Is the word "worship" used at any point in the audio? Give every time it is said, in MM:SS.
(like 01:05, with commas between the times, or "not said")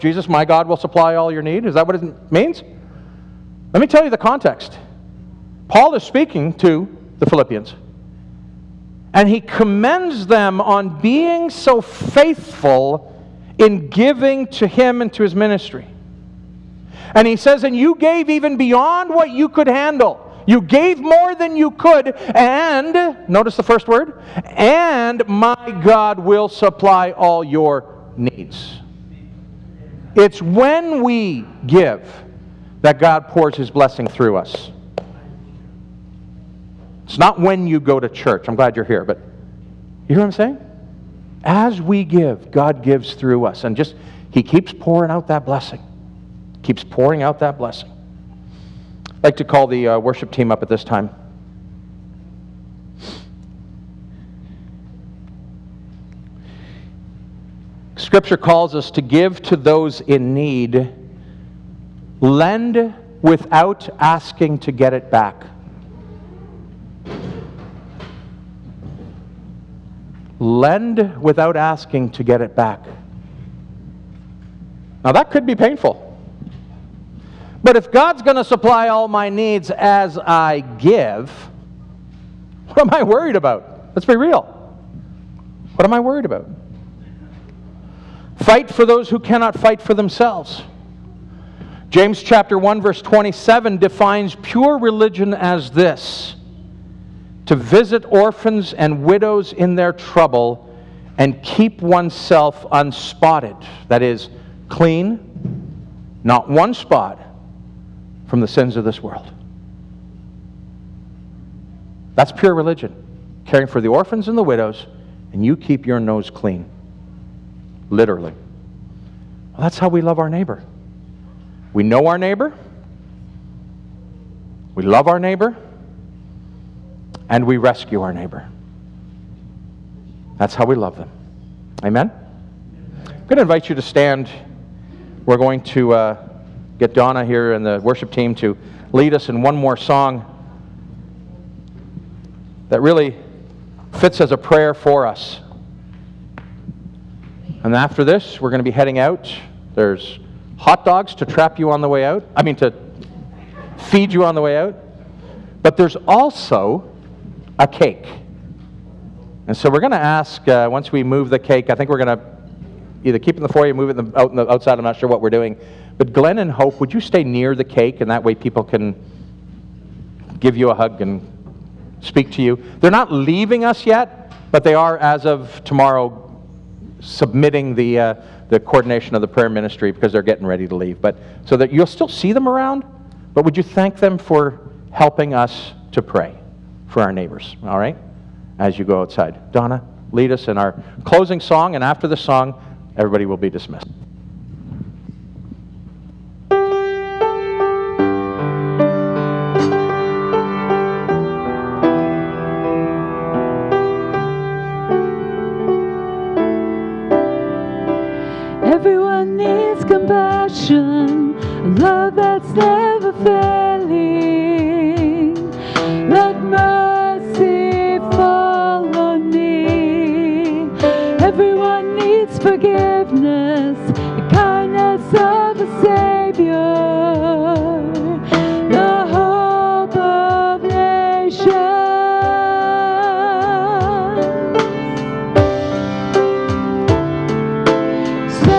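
00:49, 02:17.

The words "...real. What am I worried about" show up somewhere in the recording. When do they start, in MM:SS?
01:24.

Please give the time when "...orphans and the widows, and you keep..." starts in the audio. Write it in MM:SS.
01:53.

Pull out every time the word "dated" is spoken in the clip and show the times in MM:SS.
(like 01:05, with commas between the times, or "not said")
not said.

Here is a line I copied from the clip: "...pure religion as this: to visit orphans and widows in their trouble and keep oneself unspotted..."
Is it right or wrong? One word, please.
right.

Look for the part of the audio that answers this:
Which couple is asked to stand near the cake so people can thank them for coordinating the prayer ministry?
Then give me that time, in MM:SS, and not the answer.
02:46.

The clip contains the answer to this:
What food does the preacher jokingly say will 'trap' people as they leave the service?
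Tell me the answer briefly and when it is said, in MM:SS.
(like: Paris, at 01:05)
Hot dogs, at 02:30.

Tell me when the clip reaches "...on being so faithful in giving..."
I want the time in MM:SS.
00:10.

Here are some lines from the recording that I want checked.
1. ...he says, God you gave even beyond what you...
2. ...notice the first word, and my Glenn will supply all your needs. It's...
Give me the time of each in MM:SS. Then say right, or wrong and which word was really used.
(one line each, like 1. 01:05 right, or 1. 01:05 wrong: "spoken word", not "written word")
1. 00:17 wrong: "And", not "God"
2. 00:23 wrong: "God", not "Glenn".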